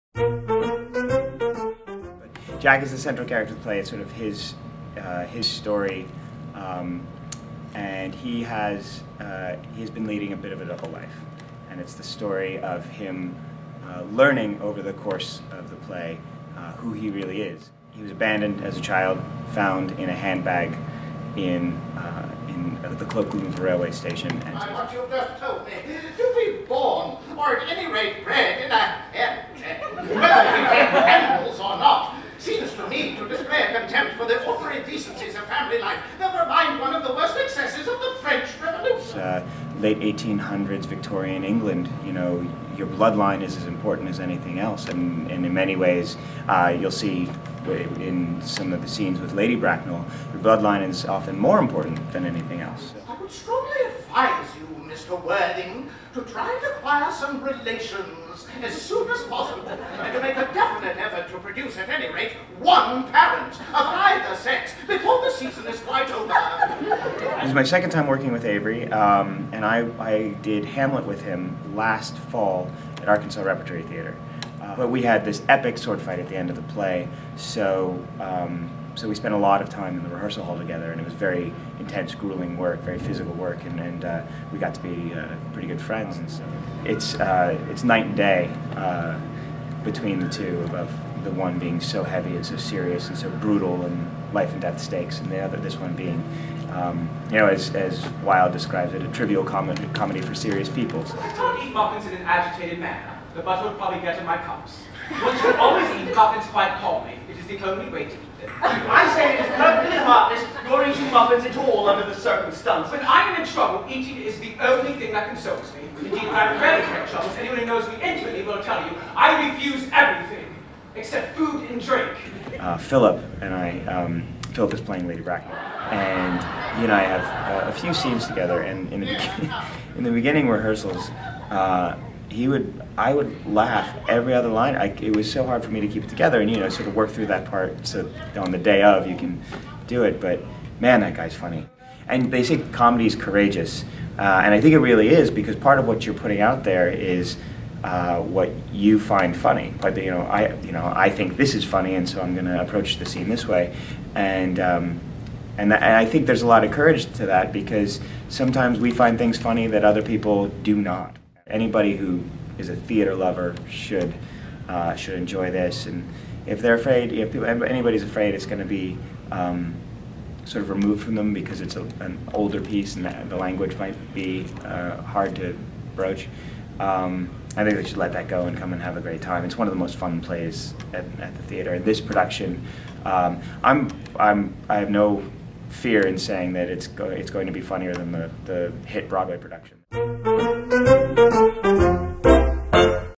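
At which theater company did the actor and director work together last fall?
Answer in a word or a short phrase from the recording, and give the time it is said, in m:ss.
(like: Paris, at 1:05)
Arkansas Repertory Theater, at 1:13.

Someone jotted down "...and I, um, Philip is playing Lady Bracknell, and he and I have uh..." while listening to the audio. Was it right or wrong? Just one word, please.
right.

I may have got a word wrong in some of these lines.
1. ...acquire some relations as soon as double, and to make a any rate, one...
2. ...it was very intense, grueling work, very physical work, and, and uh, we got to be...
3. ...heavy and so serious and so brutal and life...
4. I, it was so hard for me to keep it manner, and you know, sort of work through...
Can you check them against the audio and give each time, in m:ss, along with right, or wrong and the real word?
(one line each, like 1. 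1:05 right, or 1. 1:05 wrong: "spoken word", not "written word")
1. 0:56 wrong: "possible", not "double"
2. 1:20 right
3. 1:32 right
4. 2:14 wrong: "together", not "manner".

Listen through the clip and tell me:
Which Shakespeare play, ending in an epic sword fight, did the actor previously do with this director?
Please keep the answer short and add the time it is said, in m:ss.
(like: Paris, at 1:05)
Hamlet, at 1:10.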